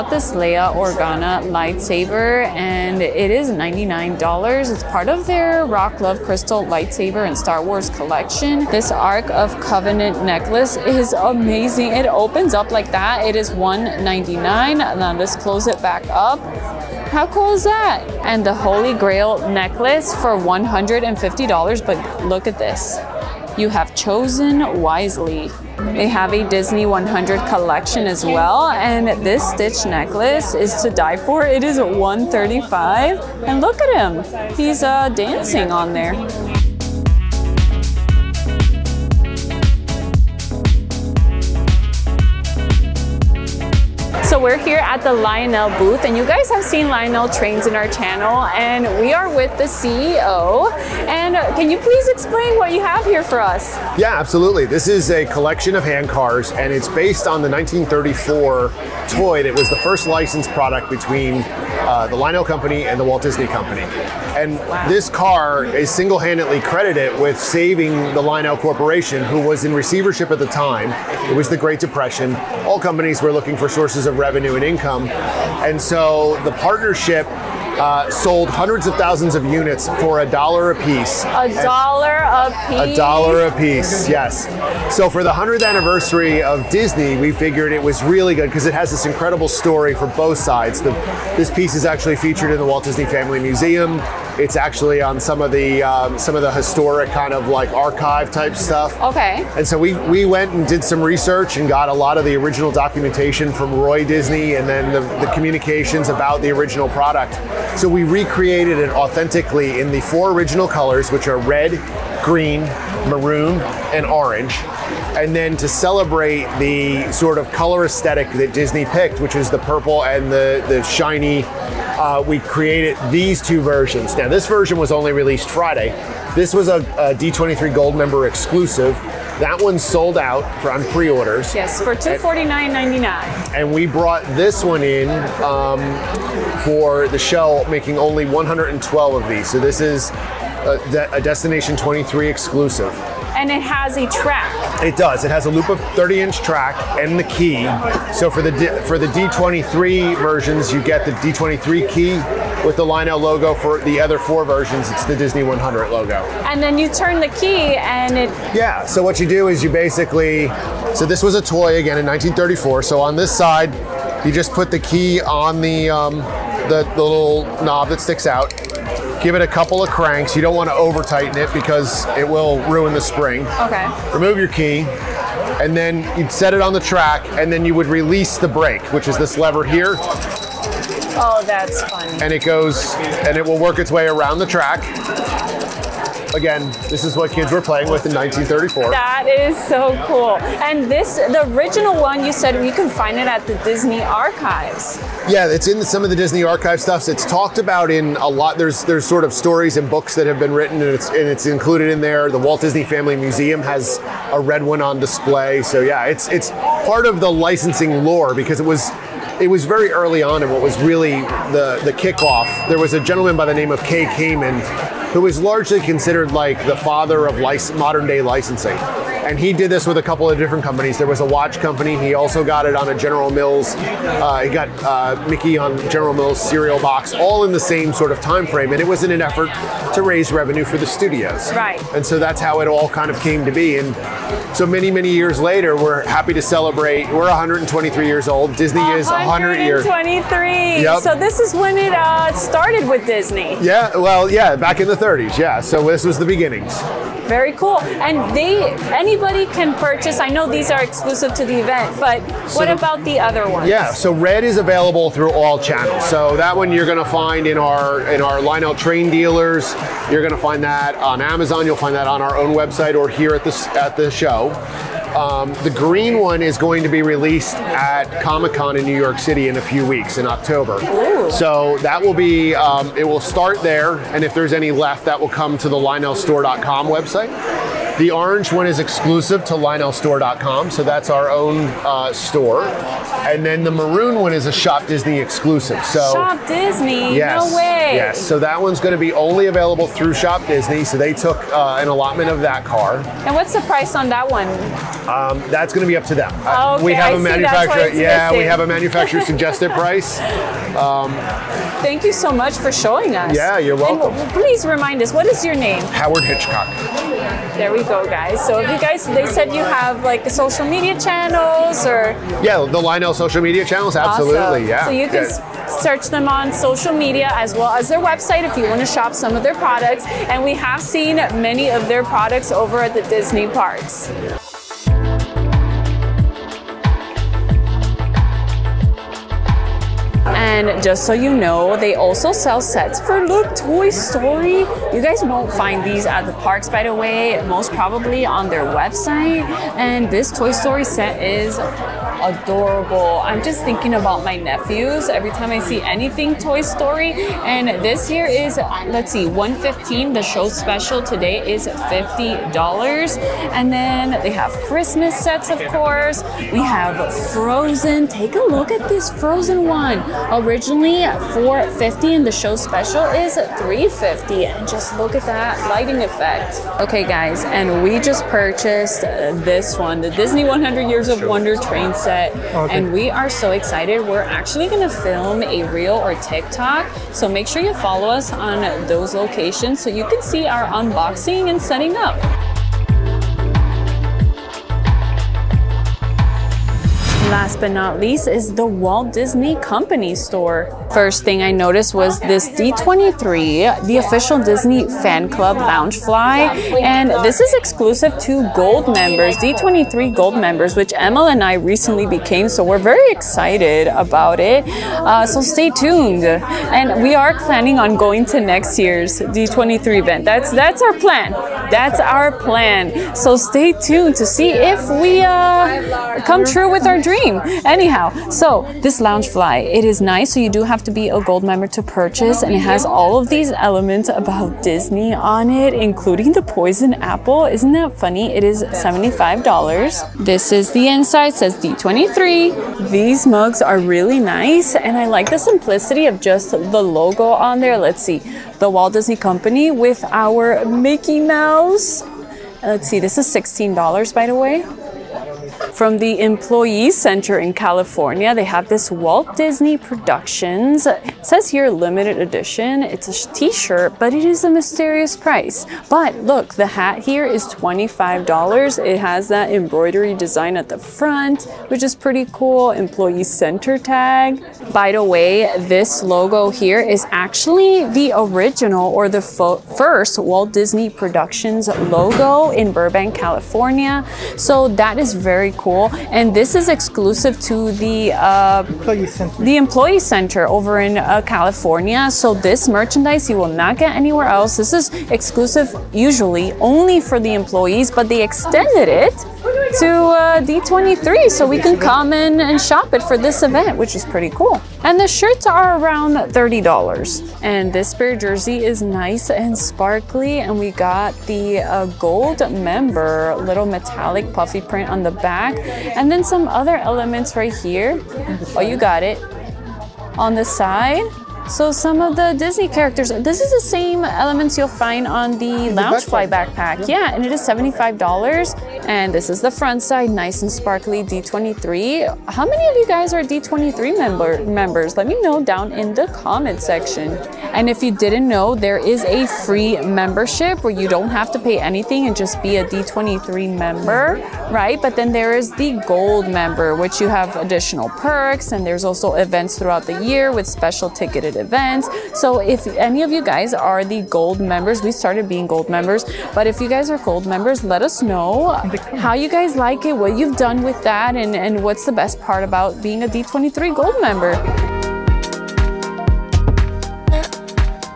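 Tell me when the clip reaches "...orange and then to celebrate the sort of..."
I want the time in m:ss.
1:54.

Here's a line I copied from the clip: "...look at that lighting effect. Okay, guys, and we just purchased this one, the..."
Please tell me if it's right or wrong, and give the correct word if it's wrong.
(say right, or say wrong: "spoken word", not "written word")
right.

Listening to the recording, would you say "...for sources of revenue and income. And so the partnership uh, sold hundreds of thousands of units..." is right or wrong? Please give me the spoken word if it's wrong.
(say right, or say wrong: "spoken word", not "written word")
right.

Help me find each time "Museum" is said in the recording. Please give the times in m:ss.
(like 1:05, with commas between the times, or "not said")
1:33, 3:23.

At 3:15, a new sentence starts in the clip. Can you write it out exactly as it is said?
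Yeah, it's in some of the Disney archive stuffs.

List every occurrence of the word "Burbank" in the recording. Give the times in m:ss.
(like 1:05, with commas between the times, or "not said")
7:52.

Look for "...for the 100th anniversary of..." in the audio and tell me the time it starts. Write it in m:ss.
1:25.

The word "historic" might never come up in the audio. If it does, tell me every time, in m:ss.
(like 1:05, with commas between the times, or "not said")
1:36.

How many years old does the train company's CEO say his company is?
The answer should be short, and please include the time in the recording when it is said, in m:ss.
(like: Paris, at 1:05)
123, at 3:57.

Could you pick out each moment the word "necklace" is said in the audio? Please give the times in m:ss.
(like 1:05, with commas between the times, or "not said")
0:10, 0:19, 0:29.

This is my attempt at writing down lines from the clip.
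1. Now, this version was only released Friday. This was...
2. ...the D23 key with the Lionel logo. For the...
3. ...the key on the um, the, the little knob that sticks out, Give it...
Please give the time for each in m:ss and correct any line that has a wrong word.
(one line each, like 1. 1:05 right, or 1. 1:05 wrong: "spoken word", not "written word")
1. 2:04 right
2. 2:31 right
3. 2:44 right.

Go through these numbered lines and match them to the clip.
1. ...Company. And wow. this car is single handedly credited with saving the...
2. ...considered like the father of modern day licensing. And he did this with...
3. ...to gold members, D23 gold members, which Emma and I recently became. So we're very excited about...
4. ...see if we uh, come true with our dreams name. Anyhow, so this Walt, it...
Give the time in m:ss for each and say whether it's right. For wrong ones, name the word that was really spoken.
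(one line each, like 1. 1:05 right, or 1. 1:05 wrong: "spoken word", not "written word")
1. 1:03 right
2. 3:35 right
3. 6:38 right
4. 6:54 wrong: "Loungefly", not "Walt".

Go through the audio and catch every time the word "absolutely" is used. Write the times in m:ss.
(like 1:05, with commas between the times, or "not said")
0:54, 5:13.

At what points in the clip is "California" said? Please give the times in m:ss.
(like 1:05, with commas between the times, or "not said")
7:27, 7:53, 8:01.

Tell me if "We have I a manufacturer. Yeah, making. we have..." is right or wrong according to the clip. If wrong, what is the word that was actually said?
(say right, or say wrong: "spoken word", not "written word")
wrong: "missing", not "making".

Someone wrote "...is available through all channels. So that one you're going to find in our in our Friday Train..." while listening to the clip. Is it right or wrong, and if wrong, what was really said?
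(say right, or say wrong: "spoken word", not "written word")
wrong: "Lionel", not "Friday".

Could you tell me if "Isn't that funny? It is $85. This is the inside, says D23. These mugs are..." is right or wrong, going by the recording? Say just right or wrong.
wrong.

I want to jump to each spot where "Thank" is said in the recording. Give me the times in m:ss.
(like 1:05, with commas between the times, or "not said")
5:01.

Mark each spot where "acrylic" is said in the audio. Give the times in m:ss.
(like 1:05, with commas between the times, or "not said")
not said.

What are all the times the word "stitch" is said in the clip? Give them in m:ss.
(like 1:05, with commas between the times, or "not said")
0:29.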